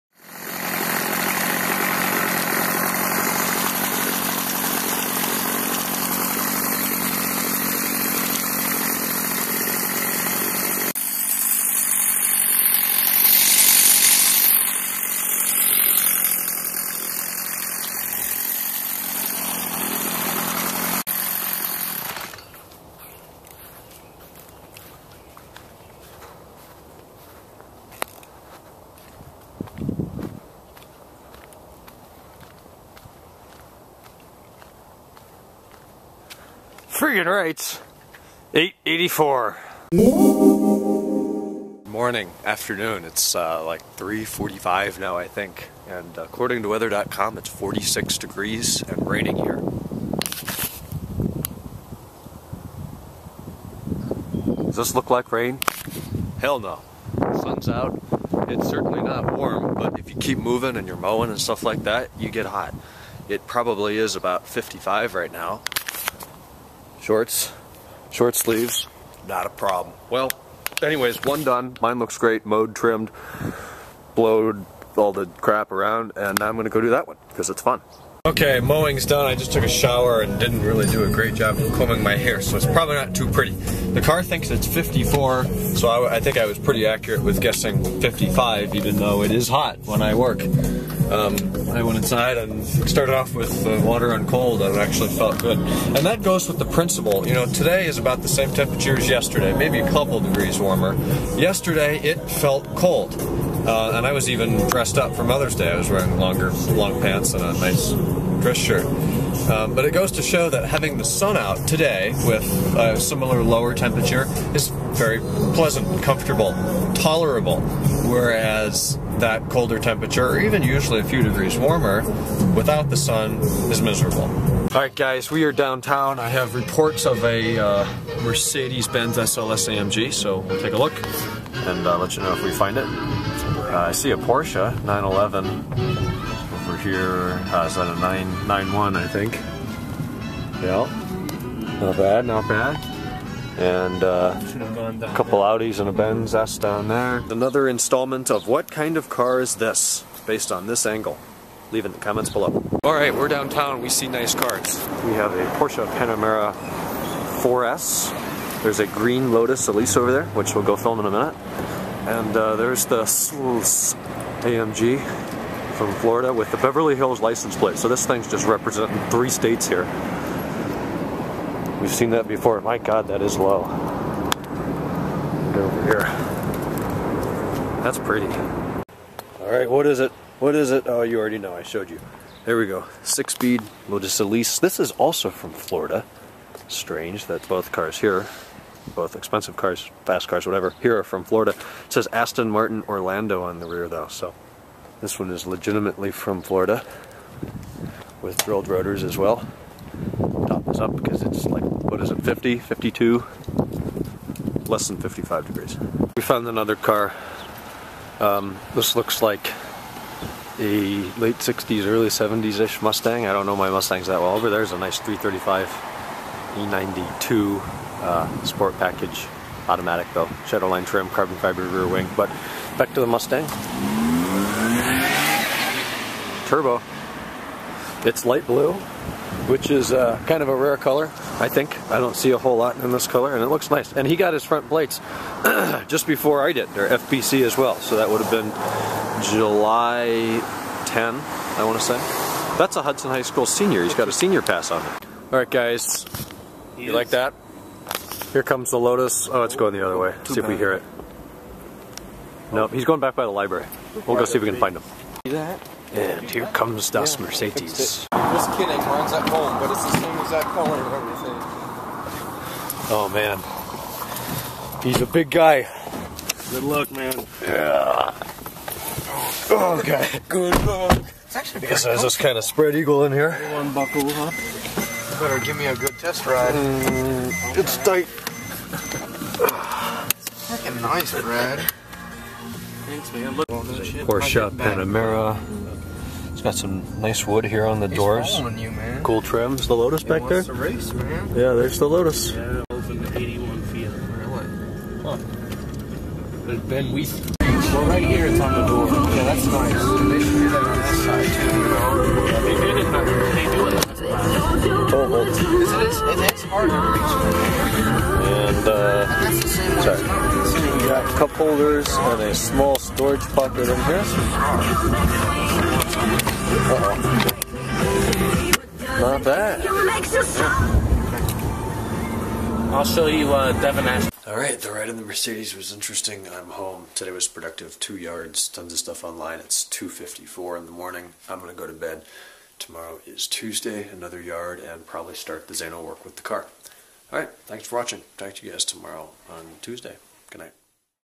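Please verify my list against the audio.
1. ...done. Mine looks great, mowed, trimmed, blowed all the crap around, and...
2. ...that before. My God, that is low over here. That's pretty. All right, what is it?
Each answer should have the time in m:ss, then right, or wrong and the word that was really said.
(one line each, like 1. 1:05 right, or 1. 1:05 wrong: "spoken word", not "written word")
1. 1:11 right
2. 2:52 right.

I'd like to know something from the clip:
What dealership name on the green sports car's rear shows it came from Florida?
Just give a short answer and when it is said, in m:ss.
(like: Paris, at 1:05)
Aston Martin Orlando, at 3:12.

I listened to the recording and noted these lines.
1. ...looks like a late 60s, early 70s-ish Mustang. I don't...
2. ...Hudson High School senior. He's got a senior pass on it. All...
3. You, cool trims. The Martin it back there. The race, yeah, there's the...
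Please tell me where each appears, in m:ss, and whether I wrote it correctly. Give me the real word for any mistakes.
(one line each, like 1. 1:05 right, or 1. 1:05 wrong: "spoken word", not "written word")
1. 3:28 right
2. 4:02 right
3. 4:48 wrong: "Lotus", not "Martin".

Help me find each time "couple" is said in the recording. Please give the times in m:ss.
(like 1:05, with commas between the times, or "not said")
1:39, 2:25.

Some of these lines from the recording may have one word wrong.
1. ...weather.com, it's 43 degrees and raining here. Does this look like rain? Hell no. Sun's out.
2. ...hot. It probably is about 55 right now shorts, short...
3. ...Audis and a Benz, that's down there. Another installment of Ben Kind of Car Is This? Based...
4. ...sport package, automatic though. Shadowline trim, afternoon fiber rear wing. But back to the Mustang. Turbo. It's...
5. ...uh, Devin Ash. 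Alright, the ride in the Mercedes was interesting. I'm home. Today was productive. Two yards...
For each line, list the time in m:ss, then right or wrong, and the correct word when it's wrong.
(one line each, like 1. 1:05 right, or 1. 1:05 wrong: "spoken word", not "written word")
1. 0:46 wrong: "46", not "43"
2. 1:02 right
3. 2:25 wrong: "What", not "Ben"
4. 3:38 wrong: "carbon", not "afternoon"
5. 5:23 right.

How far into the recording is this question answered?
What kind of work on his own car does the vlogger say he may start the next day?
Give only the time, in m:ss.
5:35.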